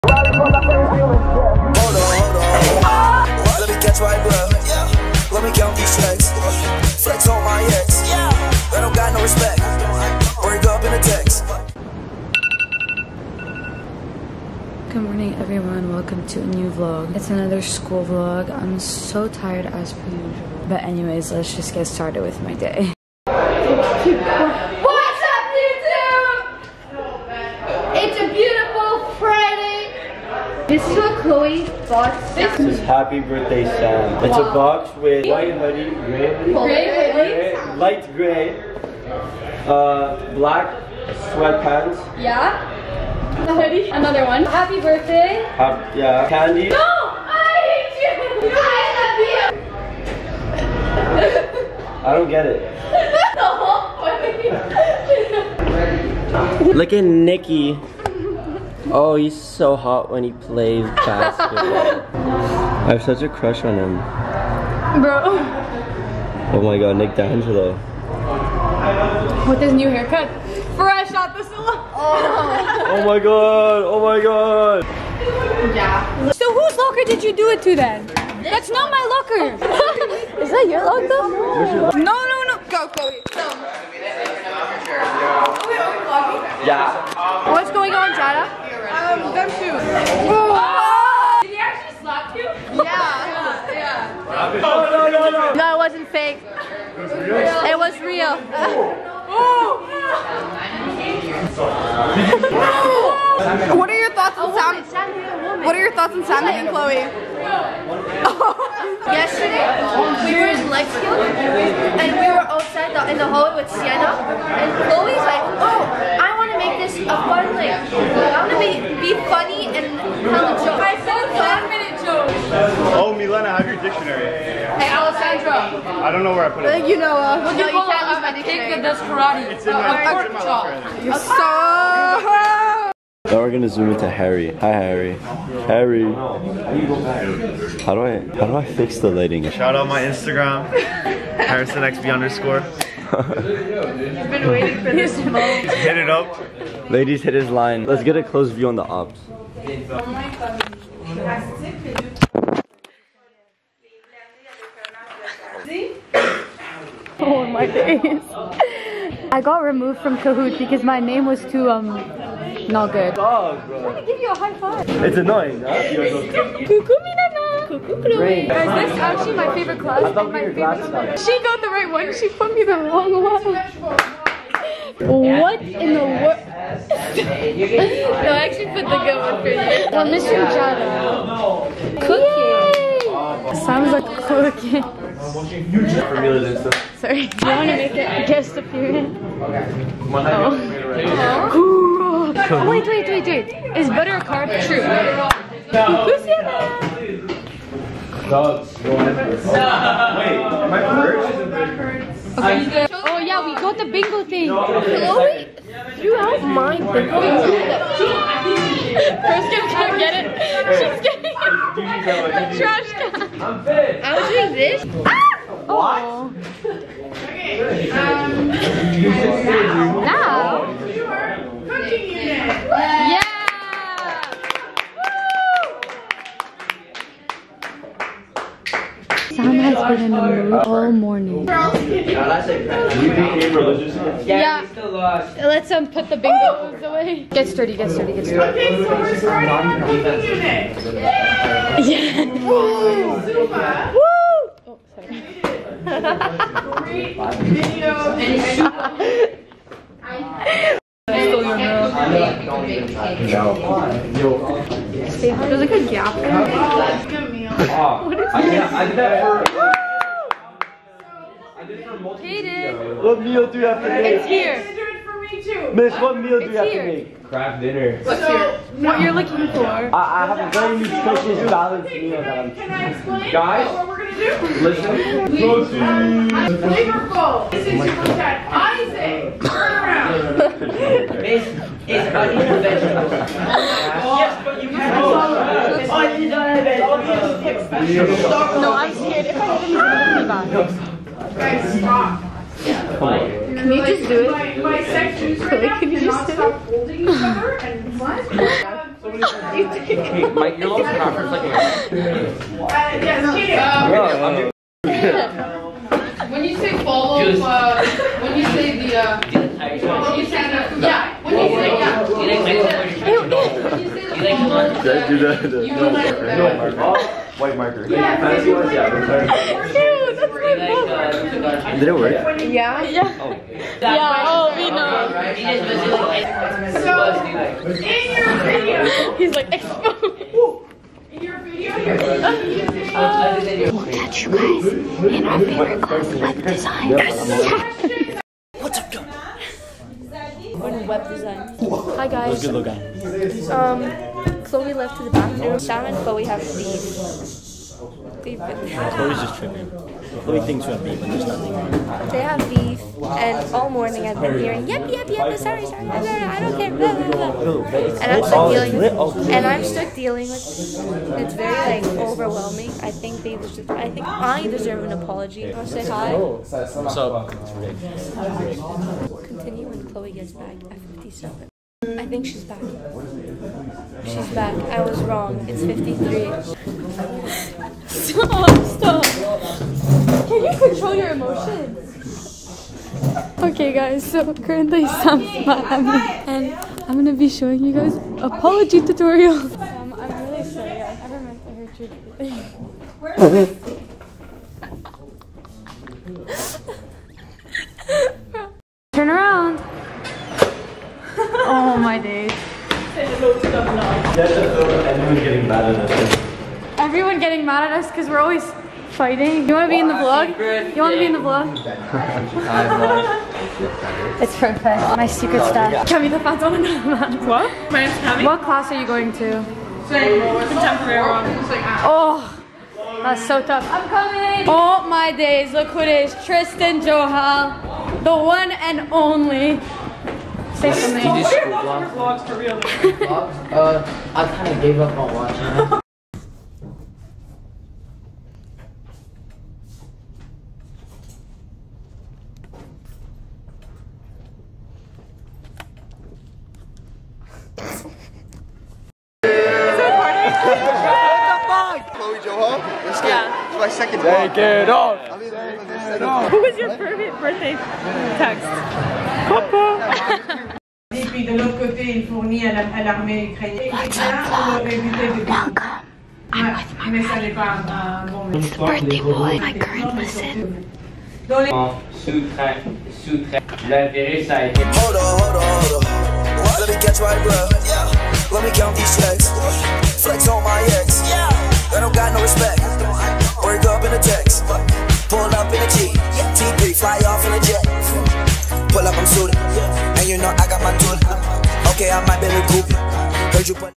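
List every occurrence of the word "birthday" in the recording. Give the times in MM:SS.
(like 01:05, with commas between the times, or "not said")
00:33, 00:44, 07:37, 07:48.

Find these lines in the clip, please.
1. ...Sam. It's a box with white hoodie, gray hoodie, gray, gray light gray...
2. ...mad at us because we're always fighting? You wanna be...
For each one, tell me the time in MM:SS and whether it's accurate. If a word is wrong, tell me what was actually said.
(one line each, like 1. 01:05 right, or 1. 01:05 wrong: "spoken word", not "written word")
1. 00:33 right
2. 06:47 right.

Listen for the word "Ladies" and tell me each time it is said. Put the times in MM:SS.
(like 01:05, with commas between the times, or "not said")
02:26.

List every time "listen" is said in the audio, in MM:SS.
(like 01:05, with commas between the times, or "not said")
04:34, 07:49.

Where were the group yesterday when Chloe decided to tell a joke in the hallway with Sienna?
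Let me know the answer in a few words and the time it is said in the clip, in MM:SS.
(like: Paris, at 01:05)
Lexington, at 01:50.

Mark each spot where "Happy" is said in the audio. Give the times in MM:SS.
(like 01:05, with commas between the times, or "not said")
00:32, 00:44.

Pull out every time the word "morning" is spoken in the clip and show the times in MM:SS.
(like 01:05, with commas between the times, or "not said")
03:50, 05:53.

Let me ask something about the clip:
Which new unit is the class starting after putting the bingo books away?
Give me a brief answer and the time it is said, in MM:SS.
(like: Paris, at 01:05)
Cooking unit, at 03:59.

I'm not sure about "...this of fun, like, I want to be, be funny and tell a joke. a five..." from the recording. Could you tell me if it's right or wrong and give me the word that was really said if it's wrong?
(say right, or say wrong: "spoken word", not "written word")
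right.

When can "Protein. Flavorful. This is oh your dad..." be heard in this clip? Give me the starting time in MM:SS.
04:34.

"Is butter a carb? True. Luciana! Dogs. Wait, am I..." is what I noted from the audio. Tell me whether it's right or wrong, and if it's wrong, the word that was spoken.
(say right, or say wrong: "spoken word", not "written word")
right.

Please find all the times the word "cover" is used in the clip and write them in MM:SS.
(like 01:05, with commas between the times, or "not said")
not said.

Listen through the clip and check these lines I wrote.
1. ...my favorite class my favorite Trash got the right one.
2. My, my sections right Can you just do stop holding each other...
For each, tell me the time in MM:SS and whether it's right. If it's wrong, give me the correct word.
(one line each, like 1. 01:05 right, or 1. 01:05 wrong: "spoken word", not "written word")
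1. 02:49 wrong: "She", not "Trash"
2. 04:54 right.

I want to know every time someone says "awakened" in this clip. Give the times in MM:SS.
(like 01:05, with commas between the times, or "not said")
not said.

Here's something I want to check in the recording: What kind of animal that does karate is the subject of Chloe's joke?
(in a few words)
A pig.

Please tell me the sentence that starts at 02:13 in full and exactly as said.
Now we're gonna zoom into Harry.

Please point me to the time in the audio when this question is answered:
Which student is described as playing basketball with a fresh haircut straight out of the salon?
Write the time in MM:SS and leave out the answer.
01:06.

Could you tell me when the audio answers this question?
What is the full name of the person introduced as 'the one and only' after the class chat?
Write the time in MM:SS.
07:06.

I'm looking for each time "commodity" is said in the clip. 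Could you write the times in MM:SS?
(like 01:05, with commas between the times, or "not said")
not said.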